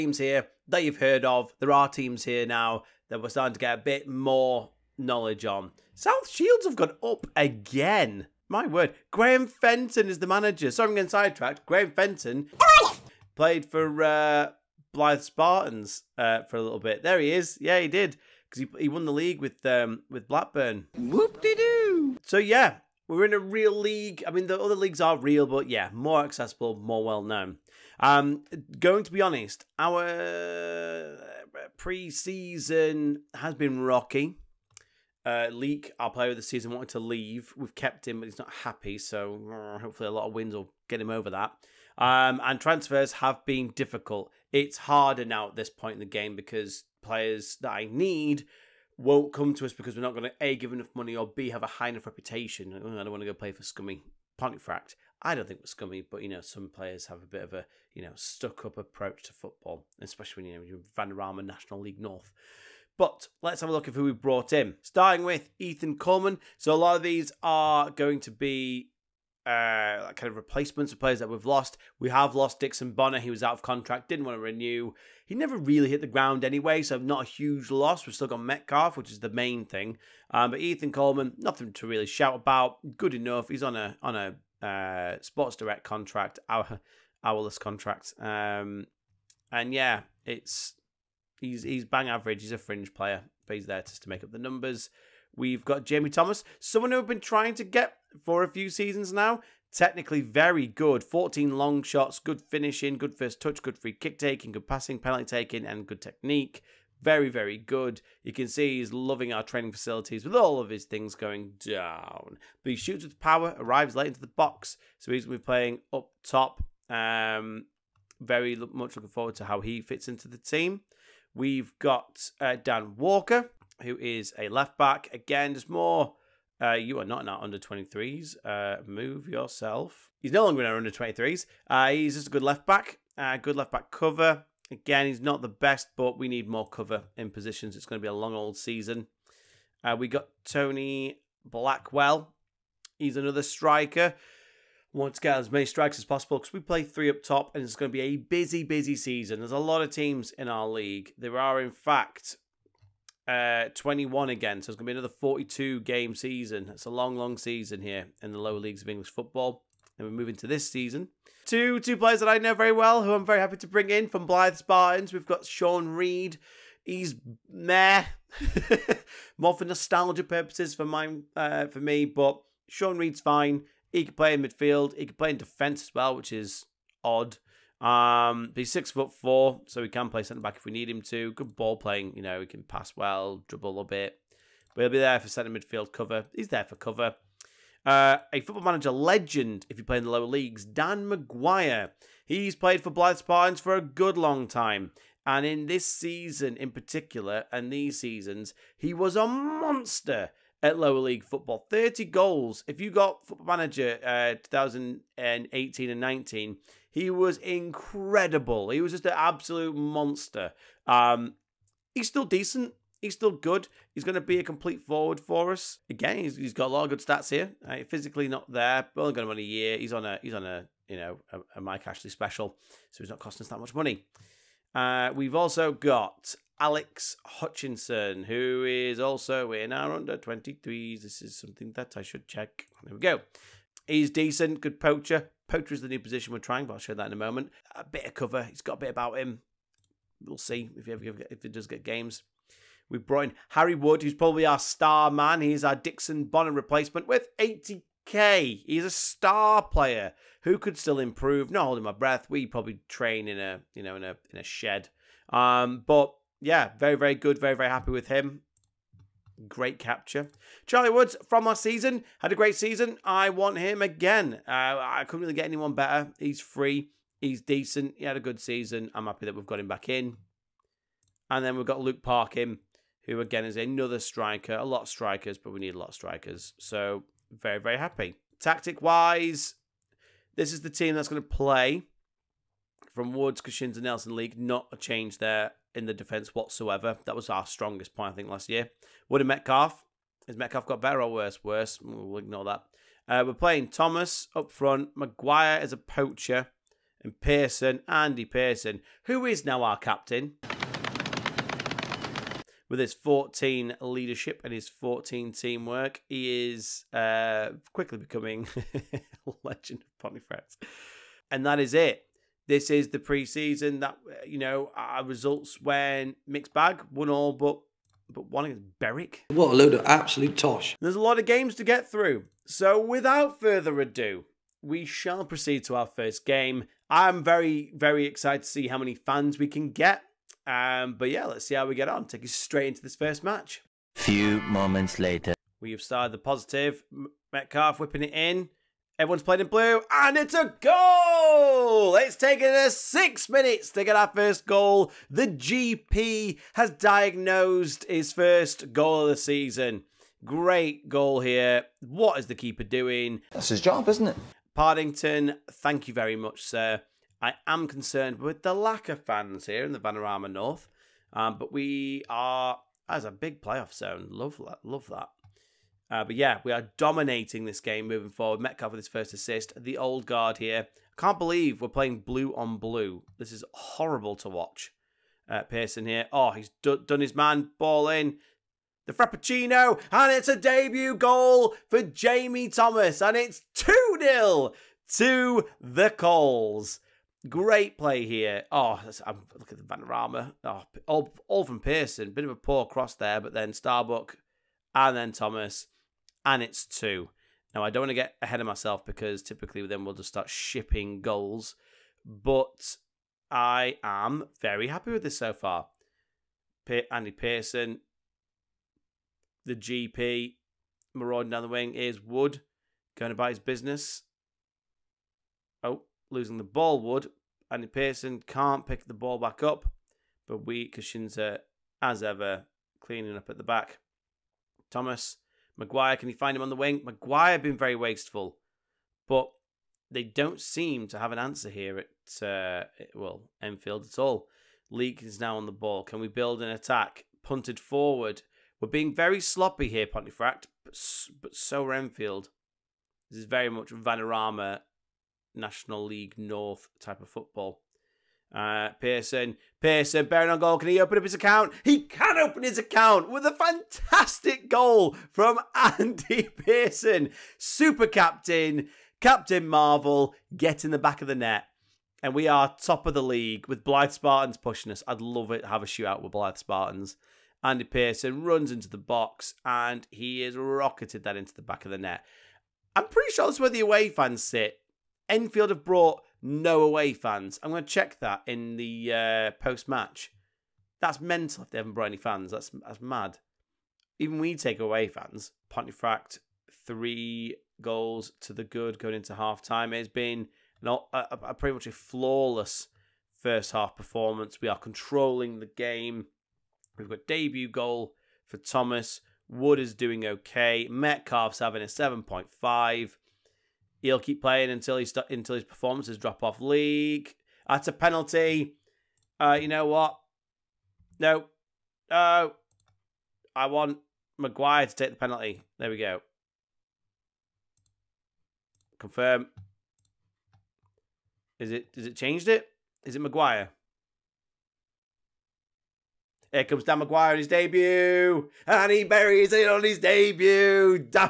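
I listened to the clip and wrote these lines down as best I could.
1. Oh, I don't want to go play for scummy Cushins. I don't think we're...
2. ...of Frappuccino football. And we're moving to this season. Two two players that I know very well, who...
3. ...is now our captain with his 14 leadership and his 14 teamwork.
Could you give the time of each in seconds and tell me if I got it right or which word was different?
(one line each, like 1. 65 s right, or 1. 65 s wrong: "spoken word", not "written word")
1. 52 s wrong: "Pontefract", not "Cushins"
2. 158 s wrong: "English", not "Frappuccino"
3. 299 s right.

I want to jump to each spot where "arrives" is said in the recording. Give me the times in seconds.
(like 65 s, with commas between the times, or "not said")
113 s.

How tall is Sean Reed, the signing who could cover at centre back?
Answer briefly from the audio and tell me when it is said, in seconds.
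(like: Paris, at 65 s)
six foot four, at 178 s.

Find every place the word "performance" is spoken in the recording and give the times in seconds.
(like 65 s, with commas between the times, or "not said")
493 s, 505 s.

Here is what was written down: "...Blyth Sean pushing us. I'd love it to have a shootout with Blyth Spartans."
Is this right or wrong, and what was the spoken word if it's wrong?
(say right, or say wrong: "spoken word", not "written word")
wrong: "Spartans", not "Sean".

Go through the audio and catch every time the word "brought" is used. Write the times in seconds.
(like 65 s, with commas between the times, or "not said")
64 s, 242 s, 475 s, 481 s.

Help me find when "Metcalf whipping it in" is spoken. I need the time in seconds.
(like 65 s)
337 s.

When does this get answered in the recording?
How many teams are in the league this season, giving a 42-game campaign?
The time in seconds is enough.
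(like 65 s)
153 s.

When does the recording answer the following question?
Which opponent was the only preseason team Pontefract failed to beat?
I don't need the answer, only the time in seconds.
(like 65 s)
318 s.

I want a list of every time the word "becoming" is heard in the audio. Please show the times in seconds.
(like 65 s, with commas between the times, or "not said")
307 s.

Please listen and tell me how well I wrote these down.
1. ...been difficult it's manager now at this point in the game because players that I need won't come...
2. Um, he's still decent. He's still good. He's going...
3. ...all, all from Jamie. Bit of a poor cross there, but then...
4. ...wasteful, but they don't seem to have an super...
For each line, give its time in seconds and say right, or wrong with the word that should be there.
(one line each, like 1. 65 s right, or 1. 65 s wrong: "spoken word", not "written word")
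1. 43 s wrong: "harder", not "manager"
2. 210 s right
3. 390 s wrong: "Pearson", not "Jamie"
4. 427 s wrong: "answer", not "super".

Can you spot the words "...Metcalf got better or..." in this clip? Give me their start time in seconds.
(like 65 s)
290 s.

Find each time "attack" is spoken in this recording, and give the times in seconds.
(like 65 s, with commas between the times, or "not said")
436 s.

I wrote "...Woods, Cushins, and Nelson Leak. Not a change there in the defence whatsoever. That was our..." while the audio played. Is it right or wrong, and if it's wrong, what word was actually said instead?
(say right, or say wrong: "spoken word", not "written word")
right.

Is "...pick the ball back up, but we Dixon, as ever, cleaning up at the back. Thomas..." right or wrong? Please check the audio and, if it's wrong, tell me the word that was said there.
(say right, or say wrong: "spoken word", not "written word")
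wrong: "Kashinza", not "Dixon".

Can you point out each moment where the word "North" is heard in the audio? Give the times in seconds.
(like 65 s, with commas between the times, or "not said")
61 s, 360 s, 446 s.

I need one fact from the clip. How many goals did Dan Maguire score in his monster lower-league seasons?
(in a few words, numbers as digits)
30.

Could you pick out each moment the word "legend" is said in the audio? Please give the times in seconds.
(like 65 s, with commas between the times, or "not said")
188 s, 309 s.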